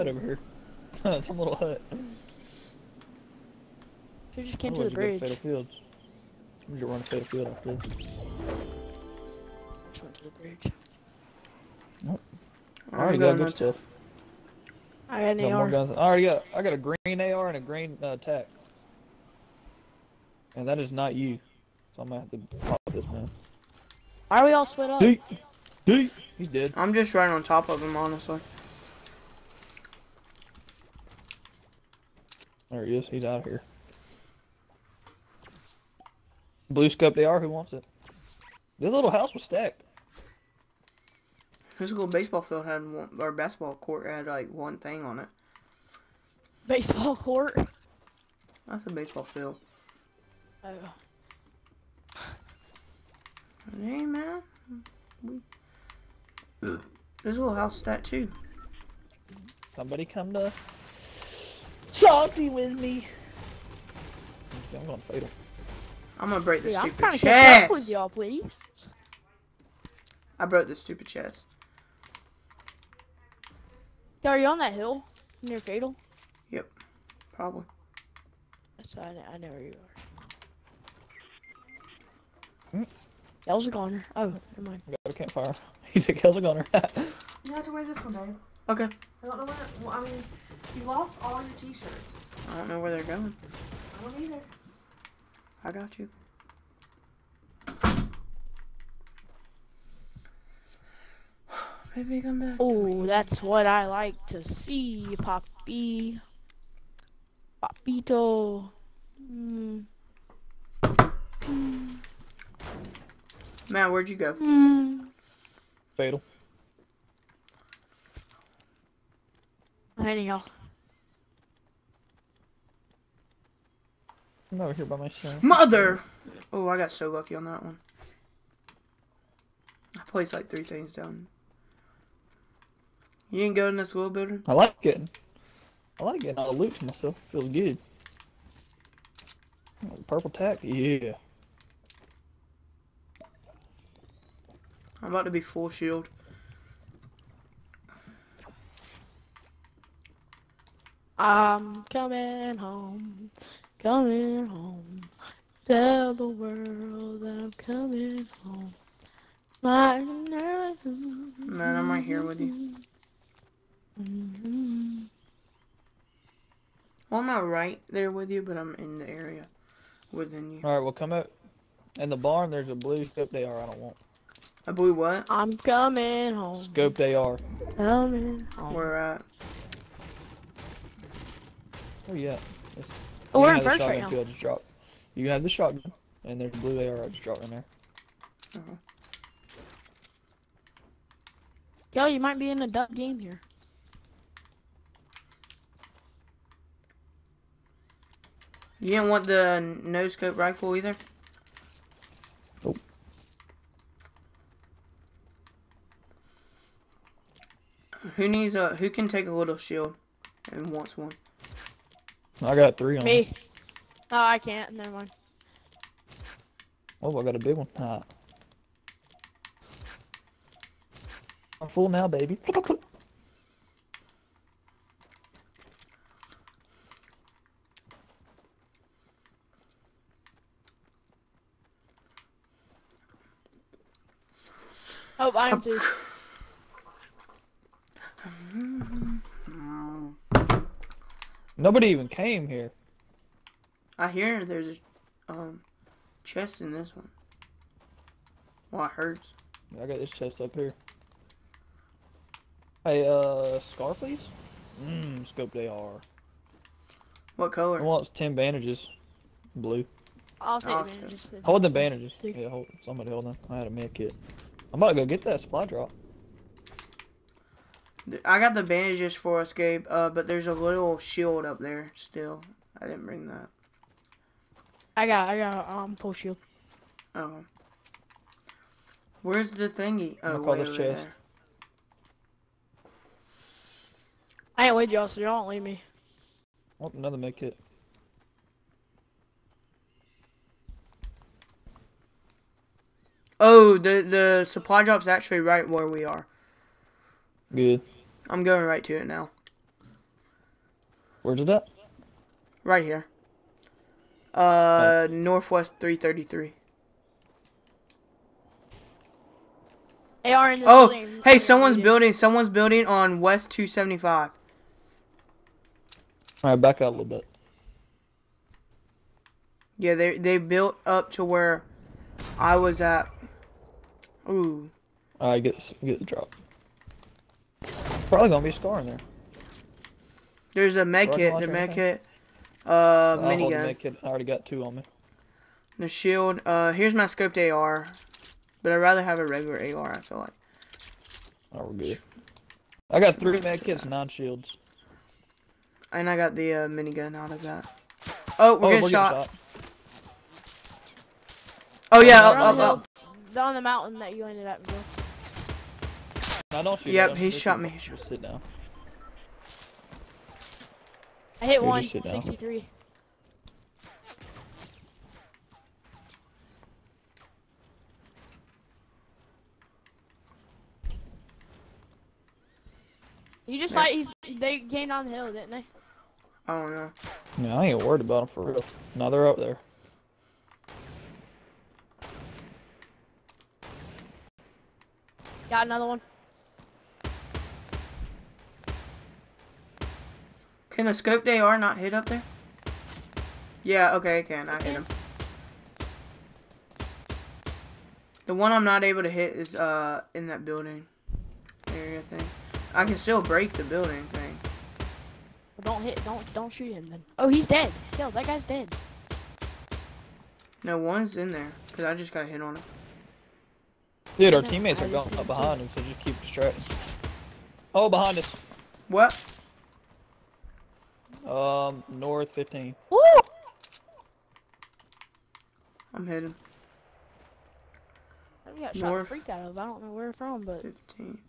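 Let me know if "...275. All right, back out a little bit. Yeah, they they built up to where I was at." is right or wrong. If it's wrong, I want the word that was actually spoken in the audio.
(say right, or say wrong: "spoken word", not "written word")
right.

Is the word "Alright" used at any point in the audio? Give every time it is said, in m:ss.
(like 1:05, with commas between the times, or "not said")
2:50.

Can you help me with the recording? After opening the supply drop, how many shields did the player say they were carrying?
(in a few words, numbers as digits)
9.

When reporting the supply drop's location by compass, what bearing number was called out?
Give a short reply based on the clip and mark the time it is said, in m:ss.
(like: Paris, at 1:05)
333, at 5:05.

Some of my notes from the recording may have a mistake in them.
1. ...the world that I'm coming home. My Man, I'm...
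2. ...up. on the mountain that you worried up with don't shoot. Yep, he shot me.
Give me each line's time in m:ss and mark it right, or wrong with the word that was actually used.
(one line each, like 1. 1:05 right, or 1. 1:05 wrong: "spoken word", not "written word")
1. 2:36 right
2. 5:52 wrong: "ended", not "worried".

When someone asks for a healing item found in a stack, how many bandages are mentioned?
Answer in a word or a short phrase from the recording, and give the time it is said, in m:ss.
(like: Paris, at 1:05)
10, at 4:18.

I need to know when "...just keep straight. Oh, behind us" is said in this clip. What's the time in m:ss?
6:55.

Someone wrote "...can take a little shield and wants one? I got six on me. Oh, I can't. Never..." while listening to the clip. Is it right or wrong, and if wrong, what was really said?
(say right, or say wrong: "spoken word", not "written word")
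wrong: "three", not "six".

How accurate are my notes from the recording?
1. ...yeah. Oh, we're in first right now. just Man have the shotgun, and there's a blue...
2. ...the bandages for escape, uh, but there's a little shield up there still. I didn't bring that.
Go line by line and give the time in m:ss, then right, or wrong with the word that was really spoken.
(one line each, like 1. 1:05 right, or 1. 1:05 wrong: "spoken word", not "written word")
1. 3:02 wrong: "You", not "Man"
2. 4:28 right.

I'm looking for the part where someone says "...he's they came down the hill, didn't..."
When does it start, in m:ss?
6:13.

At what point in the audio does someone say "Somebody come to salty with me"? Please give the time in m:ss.
0:59.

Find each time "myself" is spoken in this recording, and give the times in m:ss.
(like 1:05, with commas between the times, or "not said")
2:05, 2:16.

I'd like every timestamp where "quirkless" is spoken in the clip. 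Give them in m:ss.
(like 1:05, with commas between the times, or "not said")
not said.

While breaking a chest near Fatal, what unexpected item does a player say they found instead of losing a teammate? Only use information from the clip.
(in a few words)
A campfire.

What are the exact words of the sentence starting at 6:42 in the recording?
I can still break the building thing.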